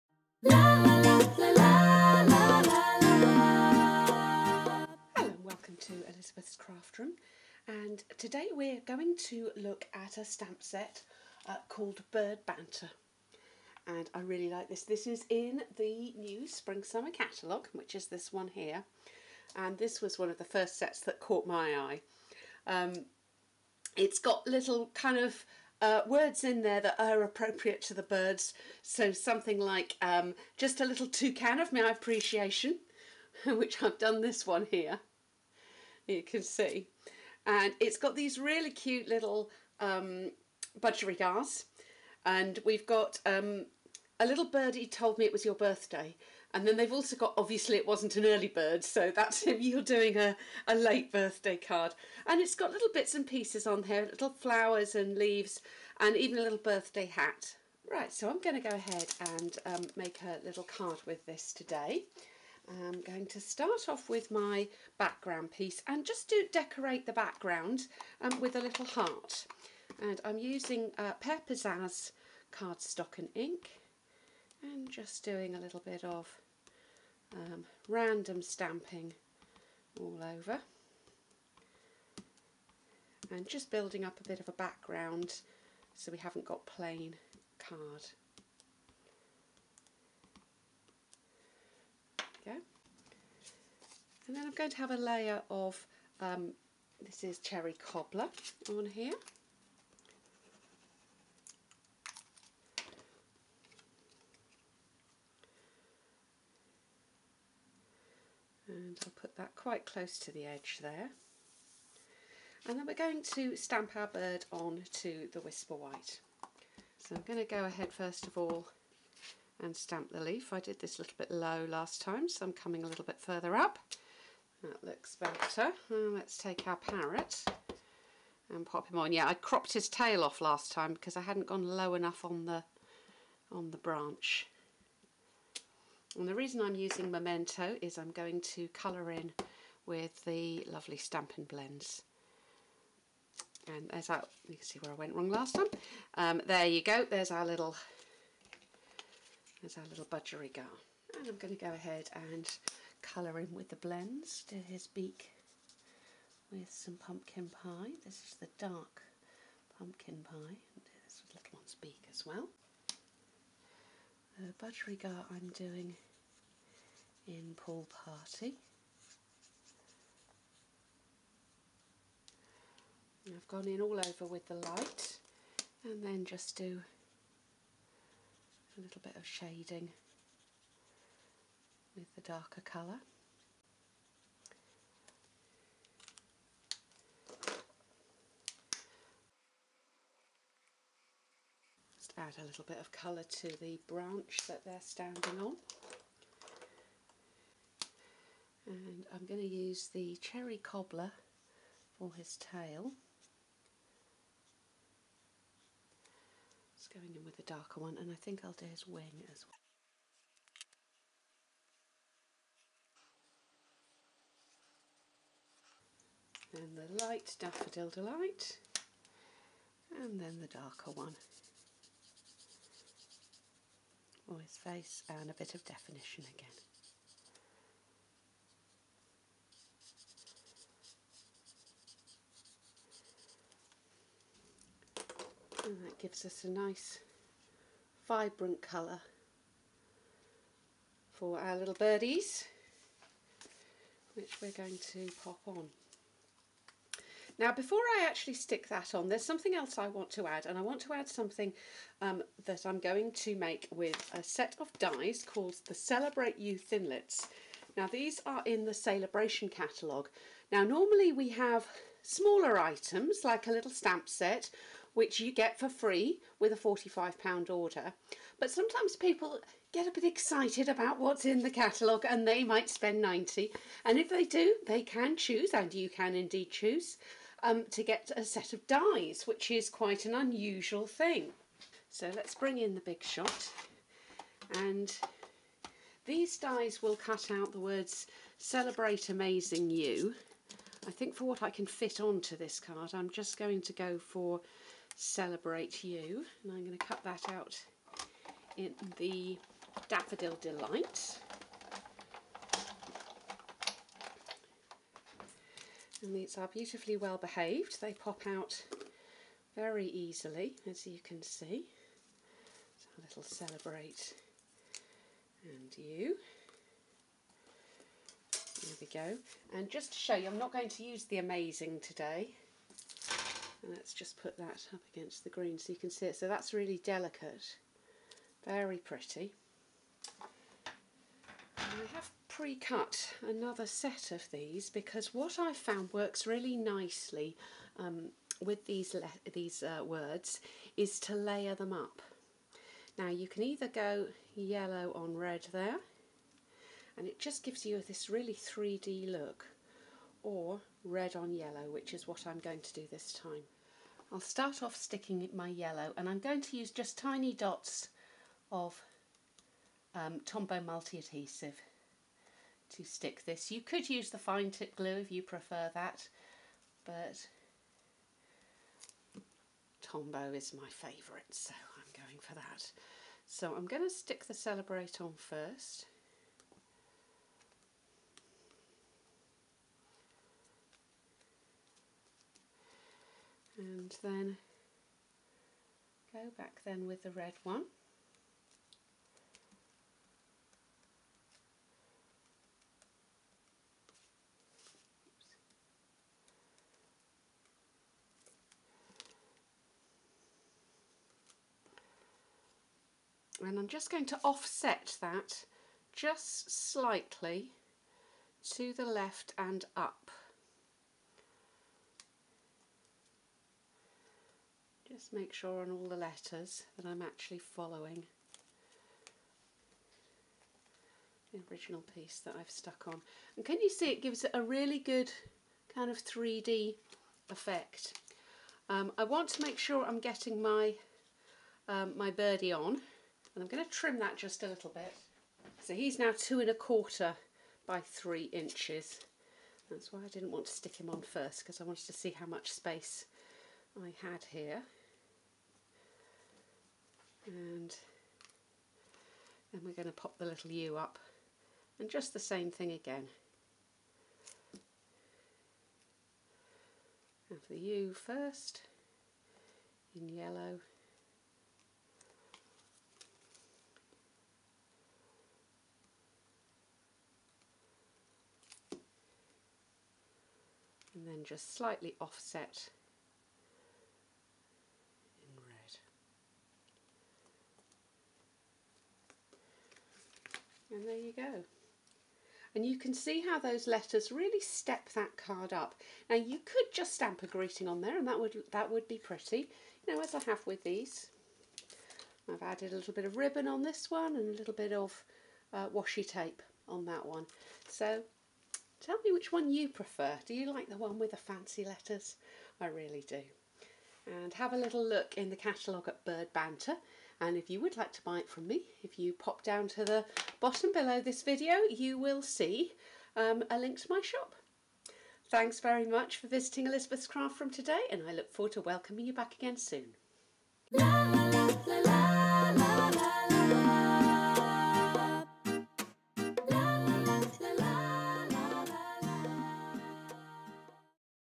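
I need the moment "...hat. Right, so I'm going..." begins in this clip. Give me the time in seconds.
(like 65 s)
57 s.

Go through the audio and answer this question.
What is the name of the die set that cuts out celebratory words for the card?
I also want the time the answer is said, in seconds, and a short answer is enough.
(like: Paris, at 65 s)
Celebrate You Thinlits, at 255 s.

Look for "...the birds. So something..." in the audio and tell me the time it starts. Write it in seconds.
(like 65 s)
27 s.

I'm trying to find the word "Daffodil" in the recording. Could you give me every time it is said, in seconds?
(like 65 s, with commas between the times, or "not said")
217 s, 299 s.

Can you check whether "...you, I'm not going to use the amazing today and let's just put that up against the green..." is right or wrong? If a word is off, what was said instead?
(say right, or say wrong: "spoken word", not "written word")
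right.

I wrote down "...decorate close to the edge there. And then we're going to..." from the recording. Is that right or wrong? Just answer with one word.
wrong.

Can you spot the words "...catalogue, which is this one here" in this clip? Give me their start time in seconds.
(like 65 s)
17 s.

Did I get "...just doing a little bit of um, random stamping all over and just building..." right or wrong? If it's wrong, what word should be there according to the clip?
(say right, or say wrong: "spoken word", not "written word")
right.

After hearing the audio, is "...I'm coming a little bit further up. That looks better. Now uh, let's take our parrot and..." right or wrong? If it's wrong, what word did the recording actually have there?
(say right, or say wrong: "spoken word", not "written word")
right.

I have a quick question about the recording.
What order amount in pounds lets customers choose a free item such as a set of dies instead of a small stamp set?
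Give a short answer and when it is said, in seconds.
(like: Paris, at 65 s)
£90, at 273 s.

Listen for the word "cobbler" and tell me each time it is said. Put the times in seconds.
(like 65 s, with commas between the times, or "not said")
97 s, 200 s.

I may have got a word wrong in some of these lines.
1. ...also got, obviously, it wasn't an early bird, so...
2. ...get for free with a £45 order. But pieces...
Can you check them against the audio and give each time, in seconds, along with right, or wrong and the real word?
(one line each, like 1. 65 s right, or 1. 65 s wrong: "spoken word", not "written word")
1. 46 s right
2. 265 s wrong: "sometimes", not "pieces".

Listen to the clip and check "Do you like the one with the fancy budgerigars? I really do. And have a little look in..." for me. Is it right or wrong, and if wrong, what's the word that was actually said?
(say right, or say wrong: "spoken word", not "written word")
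wrong: "letters", not "budgerigars".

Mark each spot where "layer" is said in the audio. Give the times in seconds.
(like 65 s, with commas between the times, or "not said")
94 s, 341 s.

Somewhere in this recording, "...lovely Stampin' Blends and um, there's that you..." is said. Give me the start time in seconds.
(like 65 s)
140 s.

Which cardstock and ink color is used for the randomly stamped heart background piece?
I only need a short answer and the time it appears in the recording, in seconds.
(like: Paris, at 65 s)
Pear Pizzazz, at 71 s.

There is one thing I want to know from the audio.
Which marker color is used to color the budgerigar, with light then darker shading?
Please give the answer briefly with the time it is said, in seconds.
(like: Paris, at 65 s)
Pool Party, at 167 s.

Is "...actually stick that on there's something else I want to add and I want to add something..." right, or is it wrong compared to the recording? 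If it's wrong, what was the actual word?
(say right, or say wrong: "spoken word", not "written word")
right.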